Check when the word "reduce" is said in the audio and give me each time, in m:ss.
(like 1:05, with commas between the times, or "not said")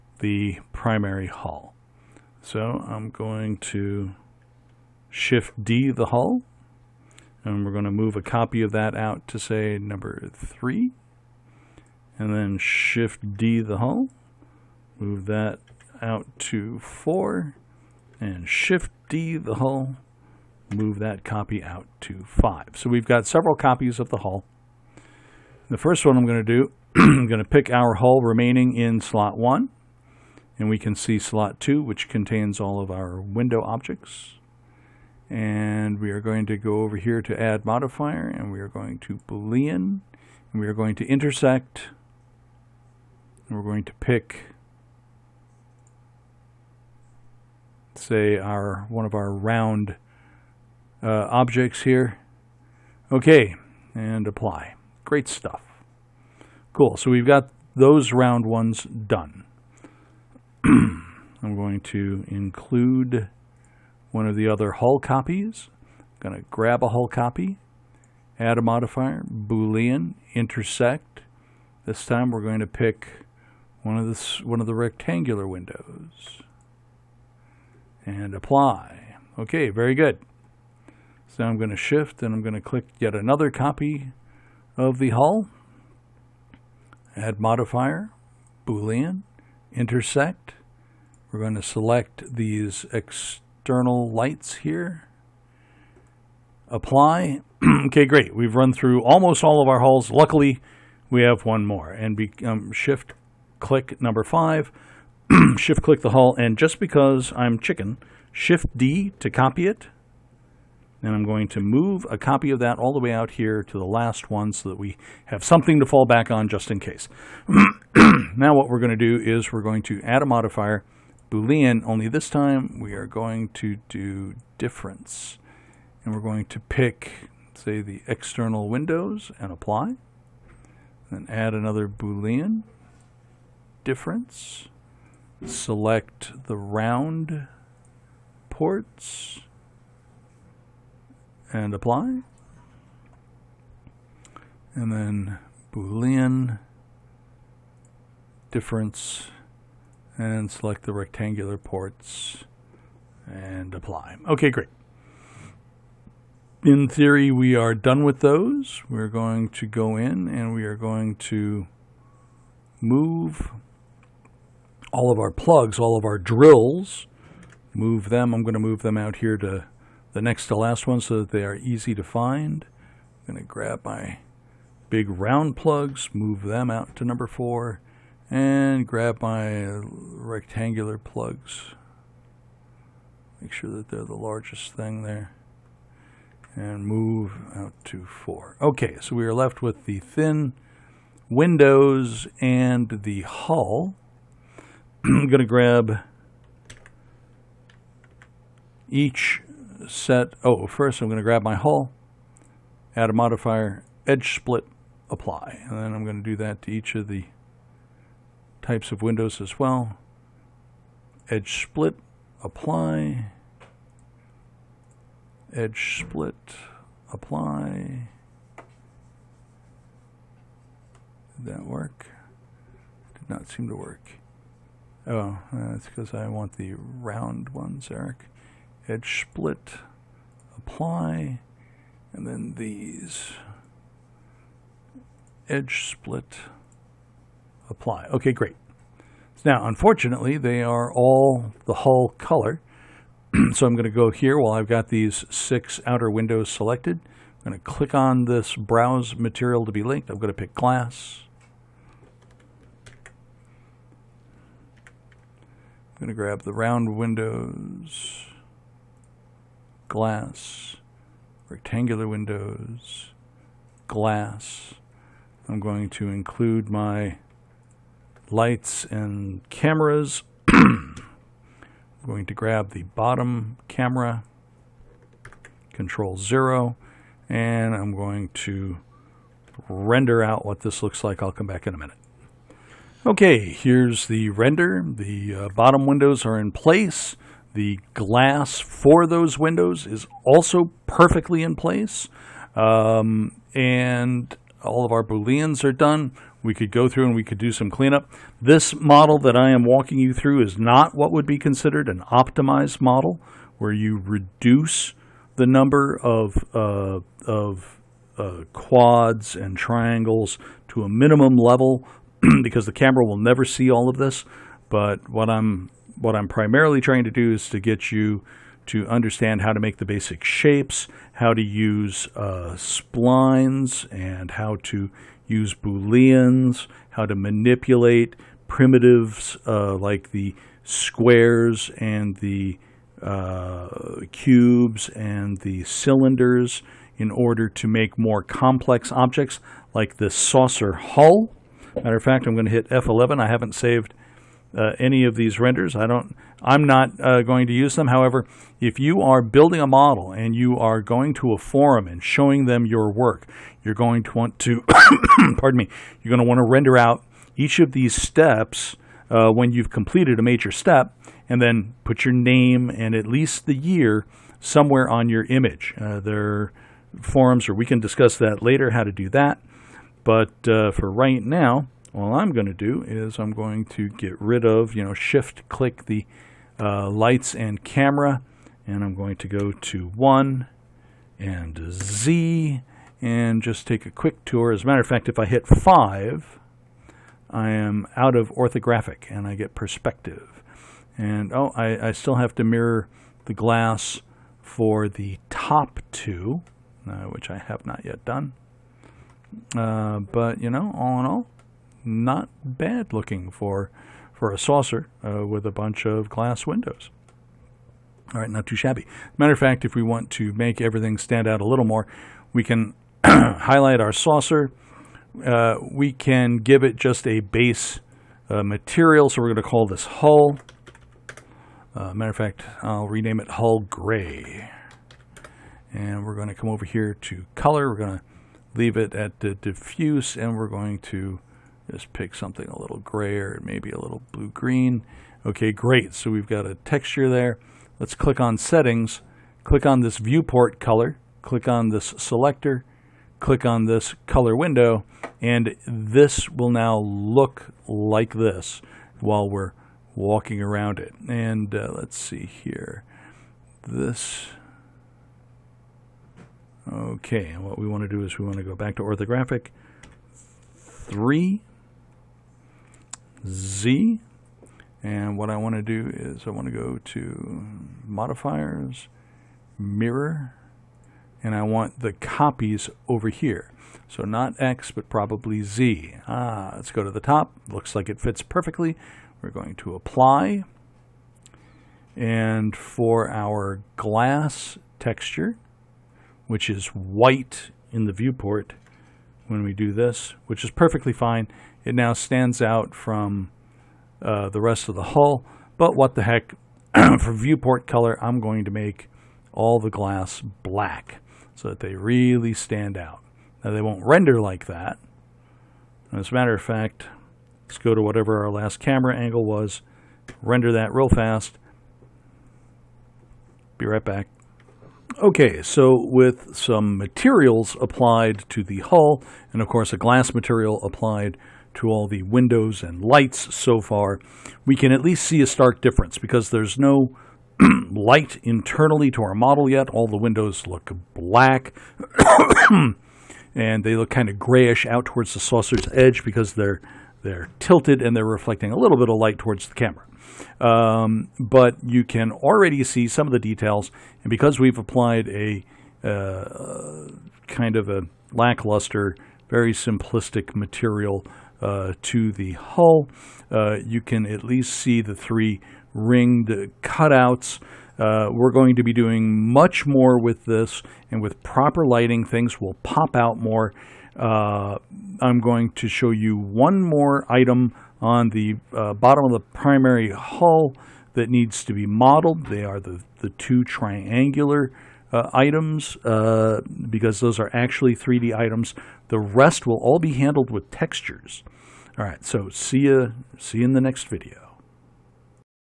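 5:04.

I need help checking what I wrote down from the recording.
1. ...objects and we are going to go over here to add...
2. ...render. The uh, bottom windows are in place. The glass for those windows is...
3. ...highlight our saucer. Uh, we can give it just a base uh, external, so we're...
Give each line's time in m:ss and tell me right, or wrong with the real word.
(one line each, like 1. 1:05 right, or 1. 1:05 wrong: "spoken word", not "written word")
1. 0:33 right
2. 4:44 right
3. 6:53 wrong: "material", not "external".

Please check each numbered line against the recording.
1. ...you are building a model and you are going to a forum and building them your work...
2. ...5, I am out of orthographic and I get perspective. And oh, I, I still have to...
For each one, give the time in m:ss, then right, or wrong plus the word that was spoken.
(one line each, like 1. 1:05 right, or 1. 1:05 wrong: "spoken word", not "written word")
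1. 5:48 wrong: "showing", not "building"
2. 6:25 right.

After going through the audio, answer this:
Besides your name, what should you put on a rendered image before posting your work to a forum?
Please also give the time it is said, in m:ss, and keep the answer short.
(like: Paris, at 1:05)
The year, at 6:03.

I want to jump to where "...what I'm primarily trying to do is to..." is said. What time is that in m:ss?
5:15.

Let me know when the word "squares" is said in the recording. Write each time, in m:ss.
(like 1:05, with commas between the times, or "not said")
5:30.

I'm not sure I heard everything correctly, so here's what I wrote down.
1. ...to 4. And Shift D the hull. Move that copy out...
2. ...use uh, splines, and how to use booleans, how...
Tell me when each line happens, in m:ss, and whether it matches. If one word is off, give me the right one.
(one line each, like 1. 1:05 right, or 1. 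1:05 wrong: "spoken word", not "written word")
1. 0:16 right
2. 5:21 right.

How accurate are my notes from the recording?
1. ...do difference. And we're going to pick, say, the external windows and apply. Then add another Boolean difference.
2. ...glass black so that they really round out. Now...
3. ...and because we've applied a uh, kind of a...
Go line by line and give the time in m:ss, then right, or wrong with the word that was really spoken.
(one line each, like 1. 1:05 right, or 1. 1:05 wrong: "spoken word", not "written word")
1. 2:03 right
2. 8:19 wrong: "stand", not "round"
3. 9:04 right.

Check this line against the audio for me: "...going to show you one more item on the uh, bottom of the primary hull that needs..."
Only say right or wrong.
right.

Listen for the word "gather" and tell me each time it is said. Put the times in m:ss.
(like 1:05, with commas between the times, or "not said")
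not said.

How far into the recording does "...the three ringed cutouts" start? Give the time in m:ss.
9:14.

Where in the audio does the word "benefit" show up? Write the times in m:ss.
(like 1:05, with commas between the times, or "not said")
not said.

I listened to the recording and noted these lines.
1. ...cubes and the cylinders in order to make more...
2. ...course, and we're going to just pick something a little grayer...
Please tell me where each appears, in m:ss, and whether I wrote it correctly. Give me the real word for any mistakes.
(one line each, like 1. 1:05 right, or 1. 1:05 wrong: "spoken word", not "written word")
1. 5:34 right
2. 7:09 wrong: "diffuse", not "course".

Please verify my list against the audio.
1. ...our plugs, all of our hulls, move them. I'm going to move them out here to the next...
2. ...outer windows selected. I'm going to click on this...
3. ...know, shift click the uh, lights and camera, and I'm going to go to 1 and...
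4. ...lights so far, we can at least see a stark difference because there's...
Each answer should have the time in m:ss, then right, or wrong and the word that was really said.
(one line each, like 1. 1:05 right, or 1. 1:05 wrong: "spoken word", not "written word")
1. 2:45 wrong: "drills", not "hulls"
2. 4:05 right
3. 6:14 right
4. 8:42 right.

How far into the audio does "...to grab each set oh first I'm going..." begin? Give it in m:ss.
3:15.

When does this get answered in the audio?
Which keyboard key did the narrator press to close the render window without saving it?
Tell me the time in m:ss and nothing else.
5:42.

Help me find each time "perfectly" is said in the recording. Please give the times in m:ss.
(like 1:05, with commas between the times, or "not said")
4:50, 7:58, 8:10.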